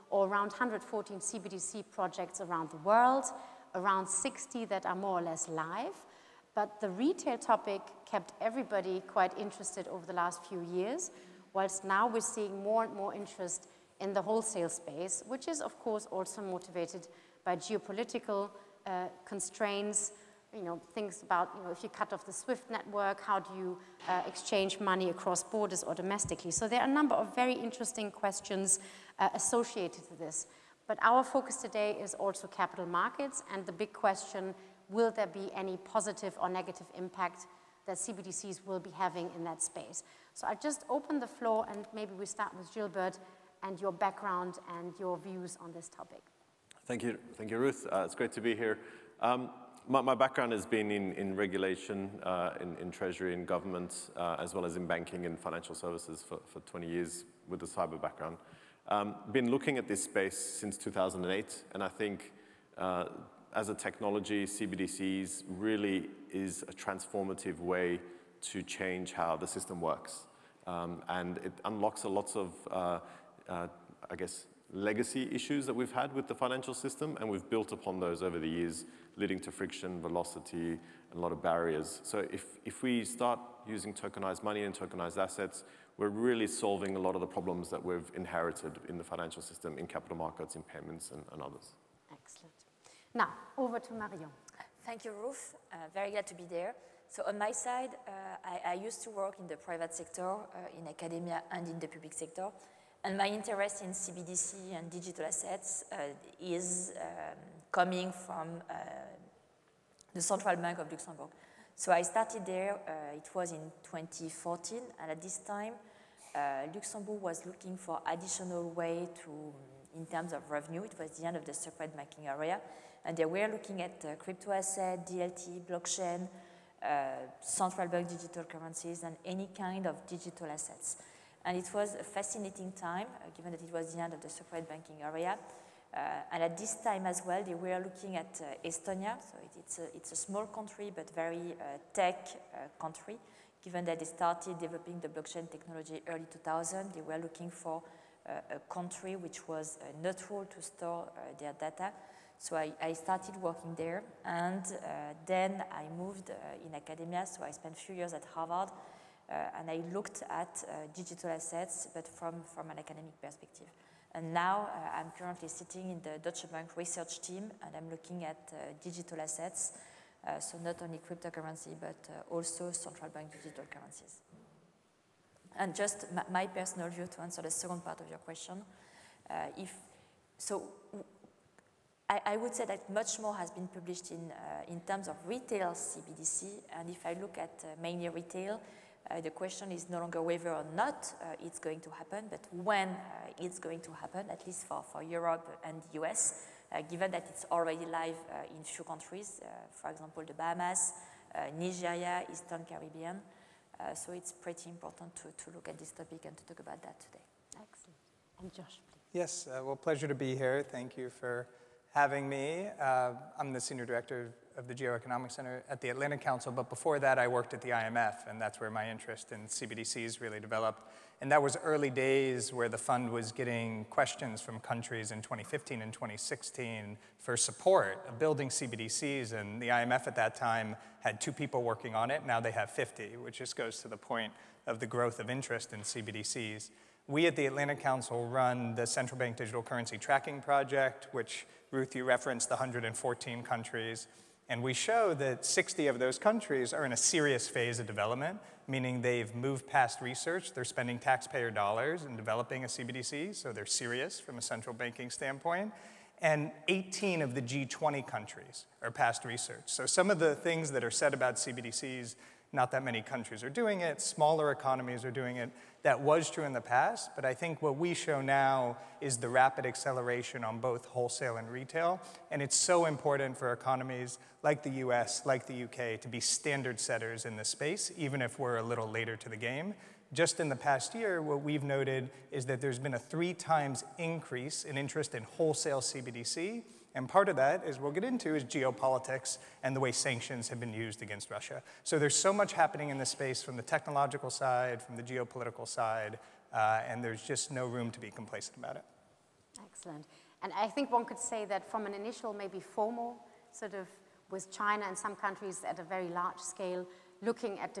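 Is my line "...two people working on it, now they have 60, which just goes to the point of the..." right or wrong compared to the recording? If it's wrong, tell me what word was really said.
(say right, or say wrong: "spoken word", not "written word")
wrong: "50", not "60".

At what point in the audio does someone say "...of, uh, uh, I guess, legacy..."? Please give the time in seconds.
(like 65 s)
72 s.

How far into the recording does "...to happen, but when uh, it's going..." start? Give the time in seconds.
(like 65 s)
191 s.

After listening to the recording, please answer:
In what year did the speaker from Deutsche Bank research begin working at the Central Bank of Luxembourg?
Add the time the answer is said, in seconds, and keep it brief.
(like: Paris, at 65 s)
2014, at 113 s.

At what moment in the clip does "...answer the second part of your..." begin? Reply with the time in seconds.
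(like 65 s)
177 s.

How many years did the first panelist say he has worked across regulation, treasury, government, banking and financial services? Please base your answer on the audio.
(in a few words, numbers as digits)
20.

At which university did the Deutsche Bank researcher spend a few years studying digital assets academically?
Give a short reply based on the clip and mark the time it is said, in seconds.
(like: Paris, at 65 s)
Harvard, at 158 s.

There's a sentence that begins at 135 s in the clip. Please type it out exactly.
Uh, and at this time as well, they were looking at uh, Estonia.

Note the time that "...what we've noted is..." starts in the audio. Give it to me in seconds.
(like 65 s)
281 s.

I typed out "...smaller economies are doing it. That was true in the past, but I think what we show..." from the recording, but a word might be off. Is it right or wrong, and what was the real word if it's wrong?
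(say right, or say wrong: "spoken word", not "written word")
right.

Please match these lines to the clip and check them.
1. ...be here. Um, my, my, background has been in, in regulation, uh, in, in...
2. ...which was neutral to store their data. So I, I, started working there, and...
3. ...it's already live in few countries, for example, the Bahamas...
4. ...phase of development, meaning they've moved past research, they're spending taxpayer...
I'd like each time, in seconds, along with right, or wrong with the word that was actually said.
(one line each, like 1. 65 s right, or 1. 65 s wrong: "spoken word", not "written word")
1. 48 s right
2. 149 s right
3. 197 s right
4. 247 s right.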